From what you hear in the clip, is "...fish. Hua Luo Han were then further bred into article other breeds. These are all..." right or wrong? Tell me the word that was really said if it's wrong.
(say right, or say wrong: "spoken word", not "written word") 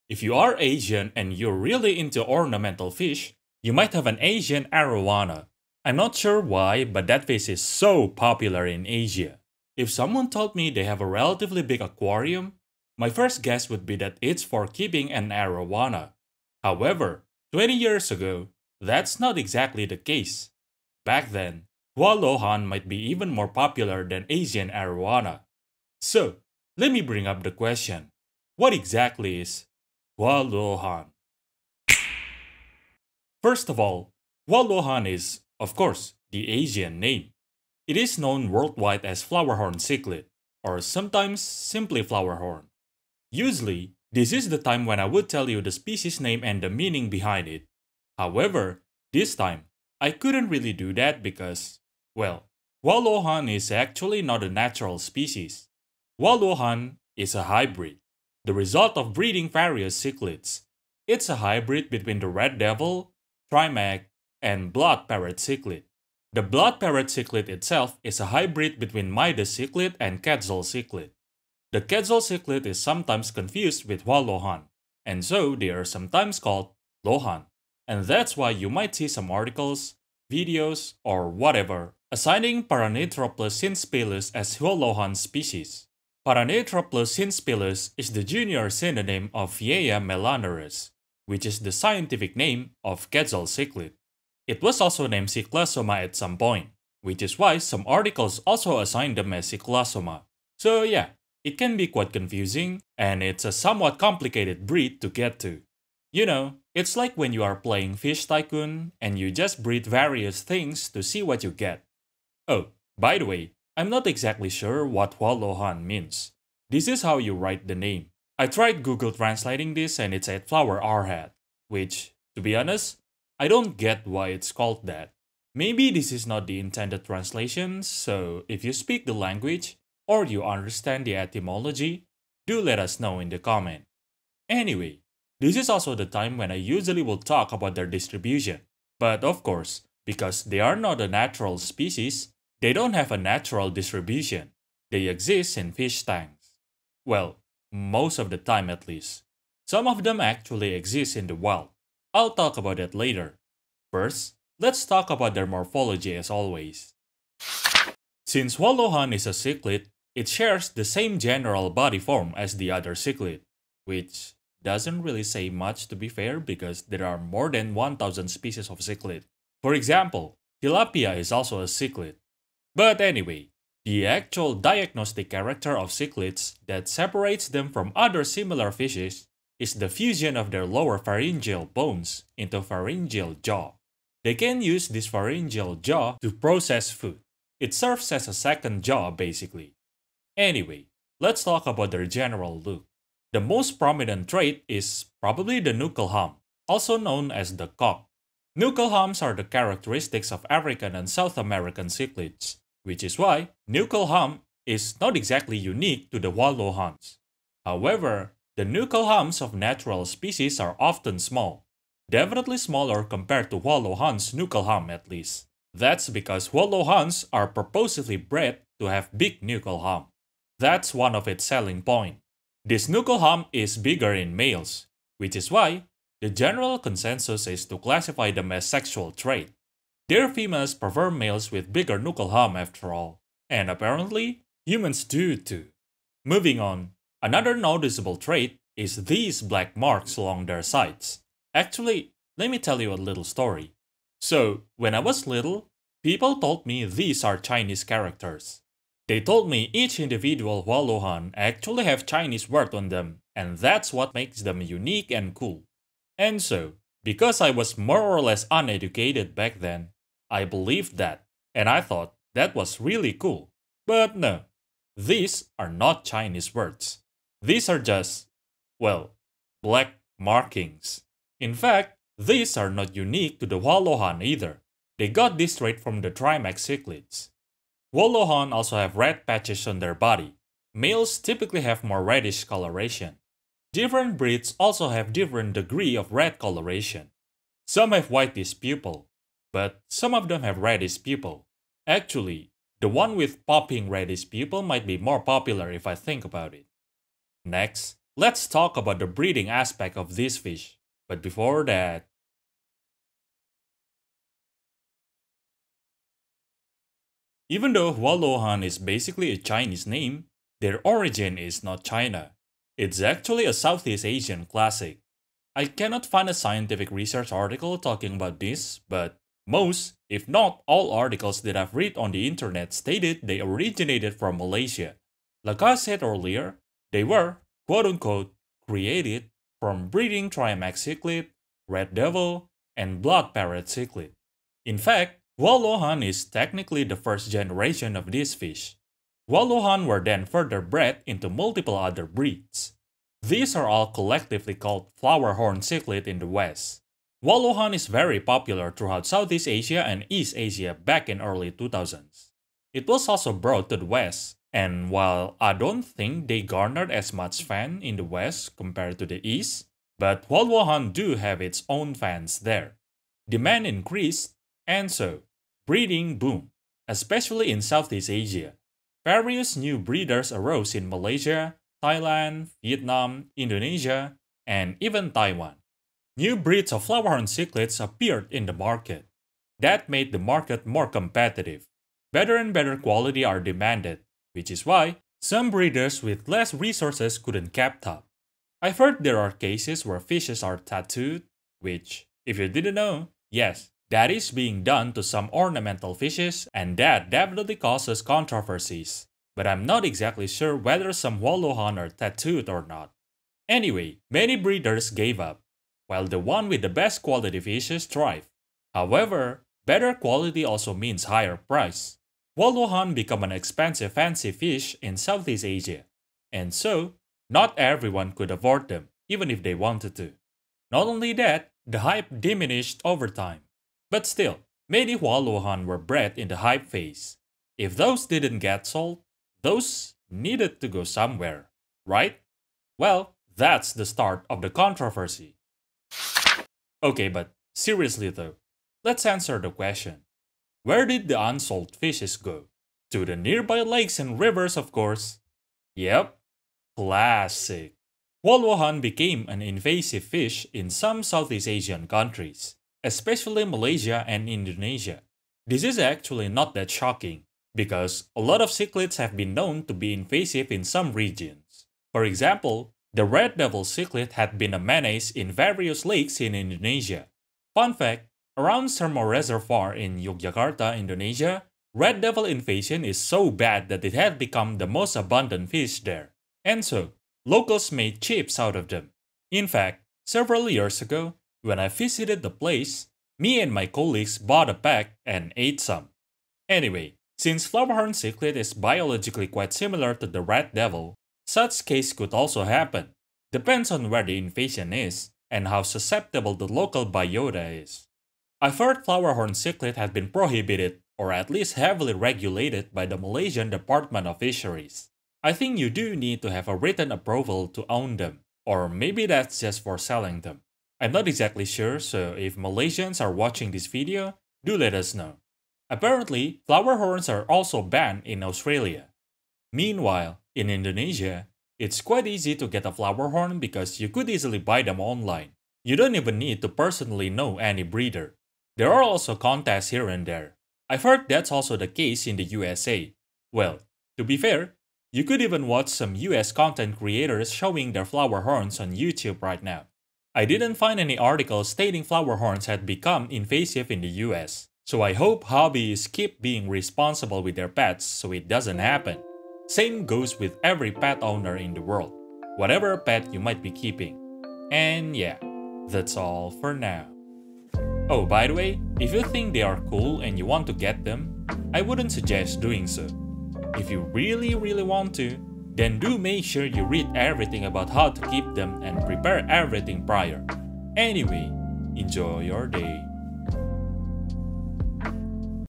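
wrong: "multiple", not "article".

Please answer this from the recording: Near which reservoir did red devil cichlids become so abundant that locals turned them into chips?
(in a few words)
Sermo Reservoir.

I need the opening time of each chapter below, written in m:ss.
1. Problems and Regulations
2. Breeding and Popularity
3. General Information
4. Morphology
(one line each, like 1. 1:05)
1. 7:16
2. 5:07
3. 0:33
4. 2:38.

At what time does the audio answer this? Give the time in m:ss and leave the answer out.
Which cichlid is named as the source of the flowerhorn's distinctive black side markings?
4:36.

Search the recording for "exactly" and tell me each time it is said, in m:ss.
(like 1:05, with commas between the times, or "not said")
0:19, 0:28, 1:54, 3:25, 6:39, 8:31.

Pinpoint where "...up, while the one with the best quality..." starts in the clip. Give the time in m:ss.
6:45.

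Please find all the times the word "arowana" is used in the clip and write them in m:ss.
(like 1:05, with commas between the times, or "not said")
0:04, 0:15, 0:24.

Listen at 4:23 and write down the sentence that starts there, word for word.
But no, these are not Chinese words.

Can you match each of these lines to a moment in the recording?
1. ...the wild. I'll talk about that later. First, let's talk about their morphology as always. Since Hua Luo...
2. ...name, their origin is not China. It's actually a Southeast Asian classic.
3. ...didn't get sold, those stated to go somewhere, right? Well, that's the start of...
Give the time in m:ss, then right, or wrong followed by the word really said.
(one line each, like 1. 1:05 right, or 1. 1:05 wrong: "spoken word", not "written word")
1. 2:31 right
2. 5:09 right
3. 7:08 wrong: "needed", not "stated".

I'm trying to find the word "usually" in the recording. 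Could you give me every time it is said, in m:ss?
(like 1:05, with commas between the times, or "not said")
0:43, 2:16.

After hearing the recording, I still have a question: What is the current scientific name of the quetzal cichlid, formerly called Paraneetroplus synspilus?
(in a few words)
Vieja melanurus.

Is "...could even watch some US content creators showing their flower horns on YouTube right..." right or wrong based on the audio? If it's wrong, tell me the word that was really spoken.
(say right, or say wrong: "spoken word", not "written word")
right.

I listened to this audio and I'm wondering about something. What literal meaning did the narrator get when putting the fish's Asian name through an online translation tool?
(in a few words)
flower arhat.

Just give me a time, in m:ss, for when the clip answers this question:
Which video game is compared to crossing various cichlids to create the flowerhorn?
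1:47.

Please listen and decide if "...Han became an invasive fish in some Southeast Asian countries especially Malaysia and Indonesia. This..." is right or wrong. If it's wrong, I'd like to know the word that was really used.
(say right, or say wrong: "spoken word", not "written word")
right.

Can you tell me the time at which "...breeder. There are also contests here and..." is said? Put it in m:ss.
8:47.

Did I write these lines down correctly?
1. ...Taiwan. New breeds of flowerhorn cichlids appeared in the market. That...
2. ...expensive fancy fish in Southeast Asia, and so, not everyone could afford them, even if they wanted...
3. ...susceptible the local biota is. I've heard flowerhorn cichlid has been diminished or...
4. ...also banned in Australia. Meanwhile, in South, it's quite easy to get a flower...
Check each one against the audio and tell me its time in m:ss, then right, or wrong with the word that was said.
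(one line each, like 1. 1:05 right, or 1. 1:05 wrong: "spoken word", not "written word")
1. 6:15 right
2. 6:53 right
3. 8:15 wrong: "prohibited", not "diminished"
4. 8:37 wrong: "Indonesia", not "South".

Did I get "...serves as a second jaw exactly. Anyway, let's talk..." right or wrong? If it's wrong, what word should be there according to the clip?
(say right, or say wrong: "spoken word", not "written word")
wrong: "basically", not "exactly".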